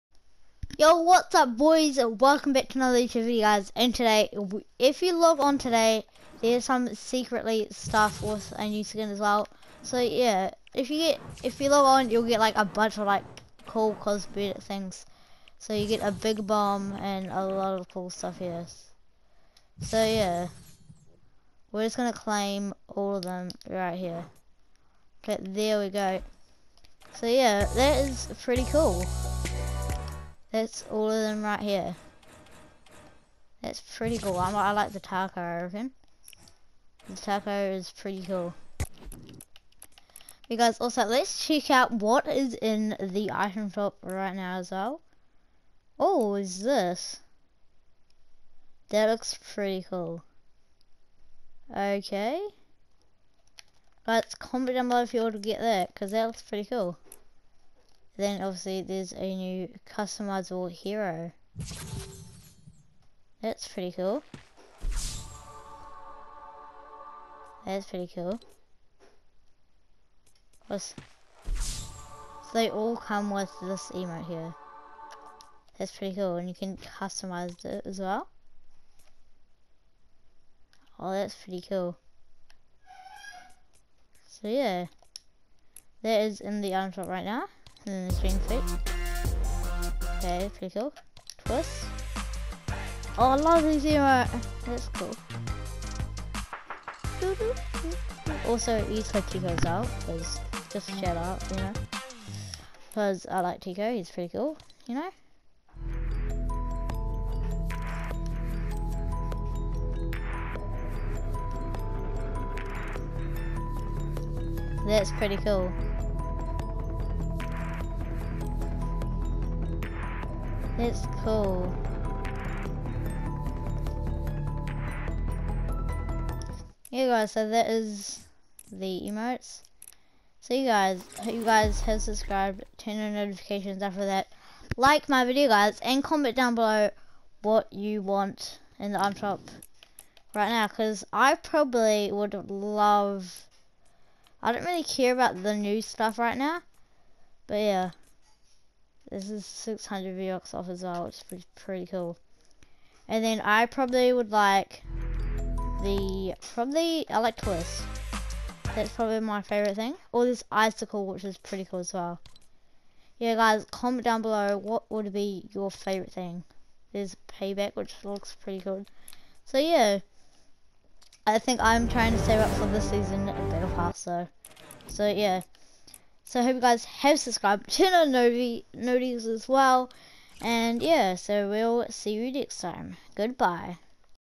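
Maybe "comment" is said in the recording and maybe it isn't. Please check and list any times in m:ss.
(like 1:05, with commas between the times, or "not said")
0:54, 2:16, 2:43.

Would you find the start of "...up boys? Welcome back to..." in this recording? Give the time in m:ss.
0:01.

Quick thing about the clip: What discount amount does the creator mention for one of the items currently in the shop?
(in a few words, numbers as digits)
600 V-Bucks.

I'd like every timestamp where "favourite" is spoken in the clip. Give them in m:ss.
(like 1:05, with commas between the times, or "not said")
2:39, 2:45.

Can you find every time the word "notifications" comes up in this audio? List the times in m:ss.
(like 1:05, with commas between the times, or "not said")
2:13, 2:58.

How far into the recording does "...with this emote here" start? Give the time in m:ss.
1:13.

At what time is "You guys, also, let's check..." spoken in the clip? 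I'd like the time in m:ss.
0:40.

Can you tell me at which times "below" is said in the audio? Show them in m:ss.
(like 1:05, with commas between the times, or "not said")
0:54, 2:16, 2:44.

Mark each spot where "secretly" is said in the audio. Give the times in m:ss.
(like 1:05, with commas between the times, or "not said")
0:06.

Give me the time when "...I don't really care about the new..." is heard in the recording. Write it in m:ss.
2:24.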